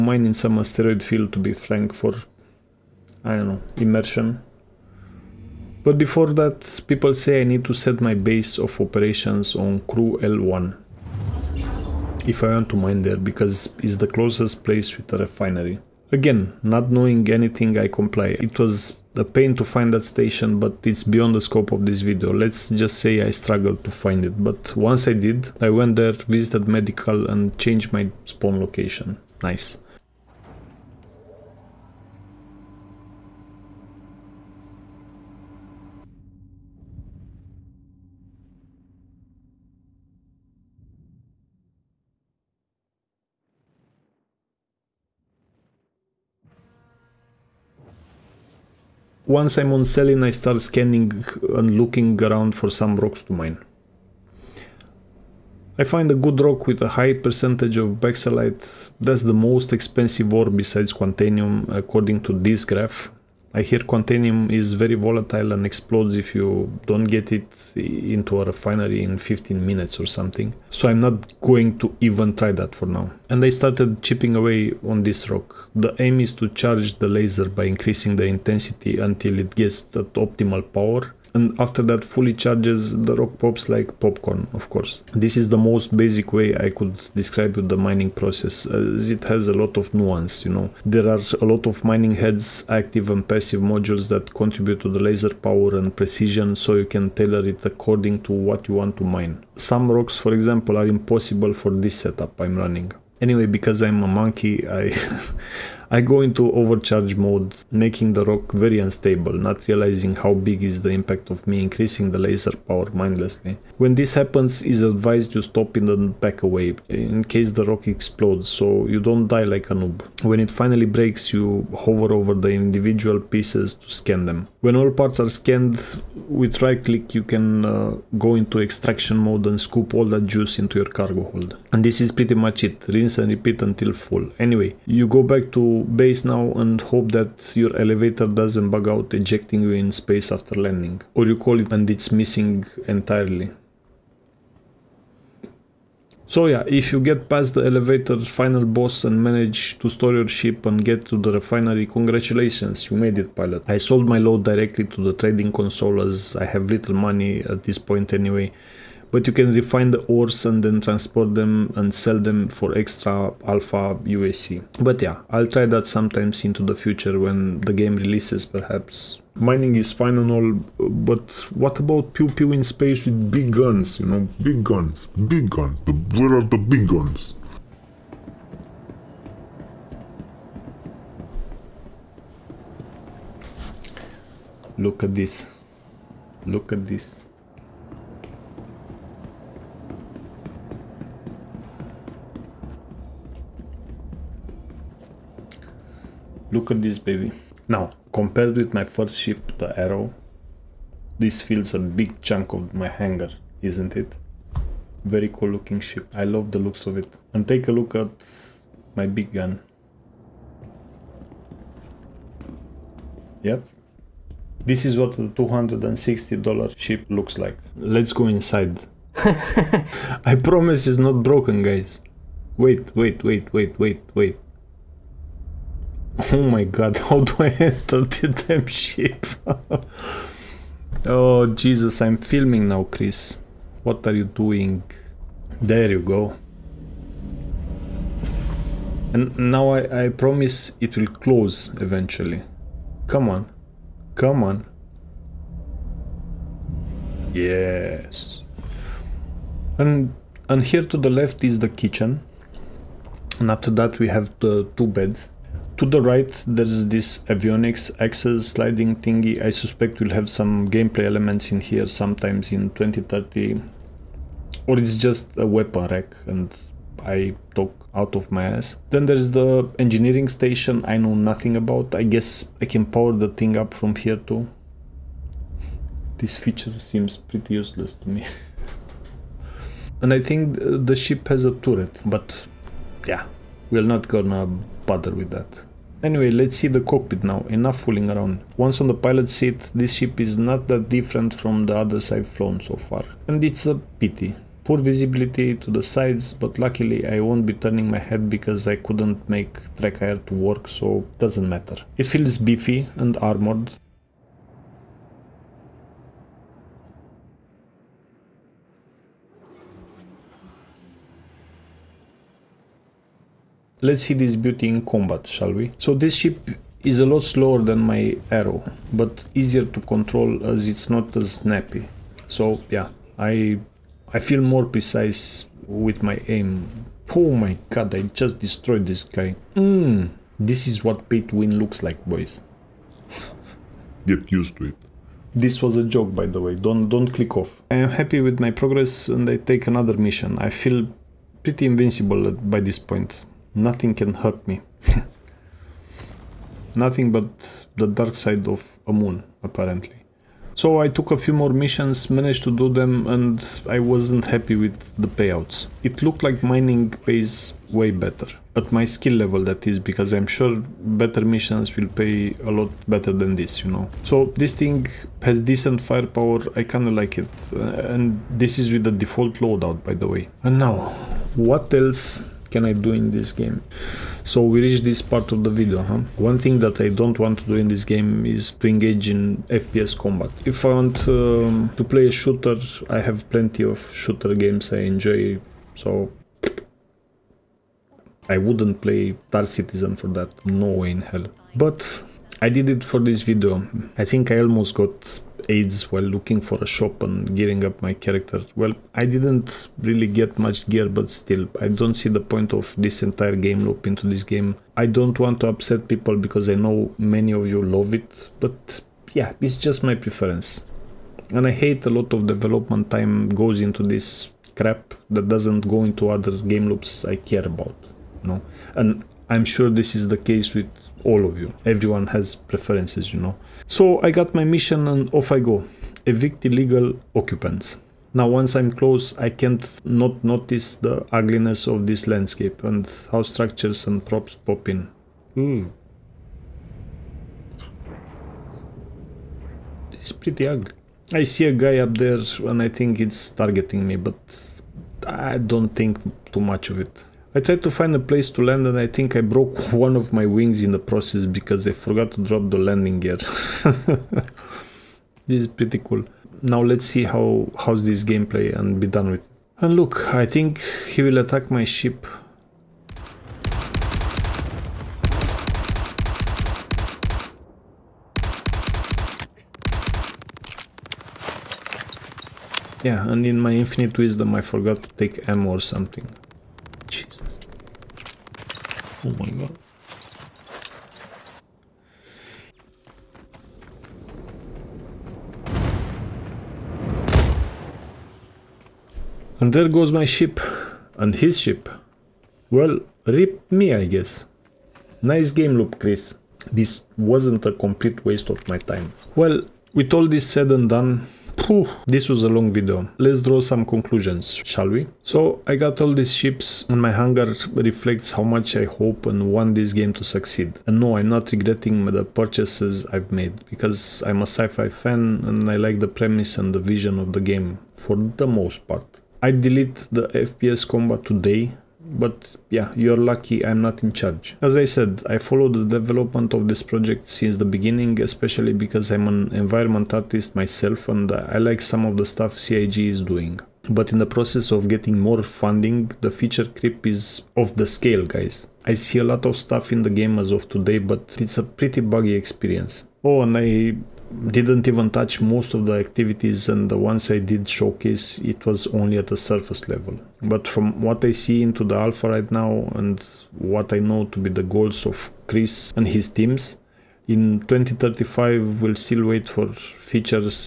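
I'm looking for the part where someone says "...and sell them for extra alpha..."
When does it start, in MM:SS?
02:41.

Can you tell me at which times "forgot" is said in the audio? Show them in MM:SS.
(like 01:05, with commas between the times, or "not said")
07:31, 07:54.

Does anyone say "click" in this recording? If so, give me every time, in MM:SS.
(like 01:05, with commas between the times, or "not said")
02:06, 05:37.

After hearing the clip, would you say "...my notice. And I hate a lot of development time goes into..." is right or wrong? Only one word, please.
wrong.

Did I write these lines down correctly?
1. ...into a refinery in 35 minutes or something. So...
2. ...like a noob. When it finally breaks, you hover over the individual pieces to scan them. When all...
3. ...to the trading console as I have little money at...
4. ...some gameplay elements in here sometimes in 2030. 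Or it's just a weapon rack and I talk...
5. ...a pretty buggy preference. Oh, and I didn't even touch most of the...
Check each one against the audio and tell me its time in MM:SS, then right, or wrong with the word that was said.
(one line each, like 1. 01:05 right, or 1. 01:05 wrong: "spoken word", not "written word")
1. 01:08 wrong: "15", not "35"
2. 01:59 right
3. 02:34 right
4. 04:20 right
5. 09:01 wrong: "experience", not "preference".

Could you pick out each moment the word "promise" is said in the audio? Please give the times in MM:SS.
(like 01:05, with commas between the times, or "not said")
03:40, 04:00.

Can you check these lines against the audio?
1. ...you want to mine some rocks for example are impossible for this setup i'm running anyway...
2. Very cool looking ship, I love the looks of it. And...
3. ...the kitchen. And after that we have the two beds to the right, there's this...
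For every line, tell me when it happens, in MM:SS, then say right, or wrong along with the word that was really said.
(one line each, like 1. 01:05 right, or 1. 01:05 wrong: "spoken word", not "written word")
1. 01:38 right
2. 03:25 right
3. 04:11 right.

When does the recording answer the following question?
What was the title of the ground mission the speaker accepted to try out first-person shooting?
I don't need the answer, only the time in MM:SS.
07:06.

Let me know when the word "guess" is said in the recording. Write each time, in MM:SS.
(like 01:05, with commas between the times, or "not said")
04:32, 08:13.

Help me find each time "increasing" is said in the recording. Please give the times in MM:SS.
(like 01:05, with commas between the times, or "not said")
01:17, 01:51.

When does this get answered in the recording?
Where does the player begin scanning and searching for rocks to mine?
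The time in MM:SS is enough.
00:49.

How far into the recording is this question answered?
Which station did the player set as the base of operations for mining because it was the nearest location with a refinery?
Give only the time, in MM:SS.
00:09.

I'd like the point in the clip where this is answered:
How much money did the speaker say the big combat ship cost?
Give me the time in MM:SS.
03:35.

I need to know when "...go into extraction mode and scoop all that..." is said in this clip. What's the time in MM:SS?
02:08.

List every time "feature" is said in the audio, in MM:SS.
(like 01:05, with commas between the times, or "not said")
04:36, 08:56, 09:19.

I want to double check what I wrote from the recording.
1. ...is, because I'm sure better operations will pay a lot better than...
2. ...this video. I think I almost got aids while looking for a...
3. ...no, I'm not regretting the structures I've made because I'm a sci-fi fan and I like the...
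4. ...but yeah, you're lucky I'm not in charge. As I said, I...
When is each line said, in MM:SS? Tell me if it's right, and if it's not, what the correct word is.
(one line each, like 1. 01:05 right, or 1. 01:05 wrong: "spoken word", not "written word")
1. 05:59 wrong: "missions", not "operations"
2. 06:32 right
3. 08:30 wrong: "purchases", not "structures"
4. 08:41 right.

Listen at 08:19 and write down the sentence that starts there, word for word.
Well, with all this said and done, Whew, this was a long video.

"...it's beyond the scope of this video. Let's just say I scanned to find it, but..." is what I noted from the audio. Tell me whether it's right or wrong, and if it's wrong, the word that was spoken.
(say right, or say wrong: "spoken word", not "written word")
wrong: "struggled", not "scanned".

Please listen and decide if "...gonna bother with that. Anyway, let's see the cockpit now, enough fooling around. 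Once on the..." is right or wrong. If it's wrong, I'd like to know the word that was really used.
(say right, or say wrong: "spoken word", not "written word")
right.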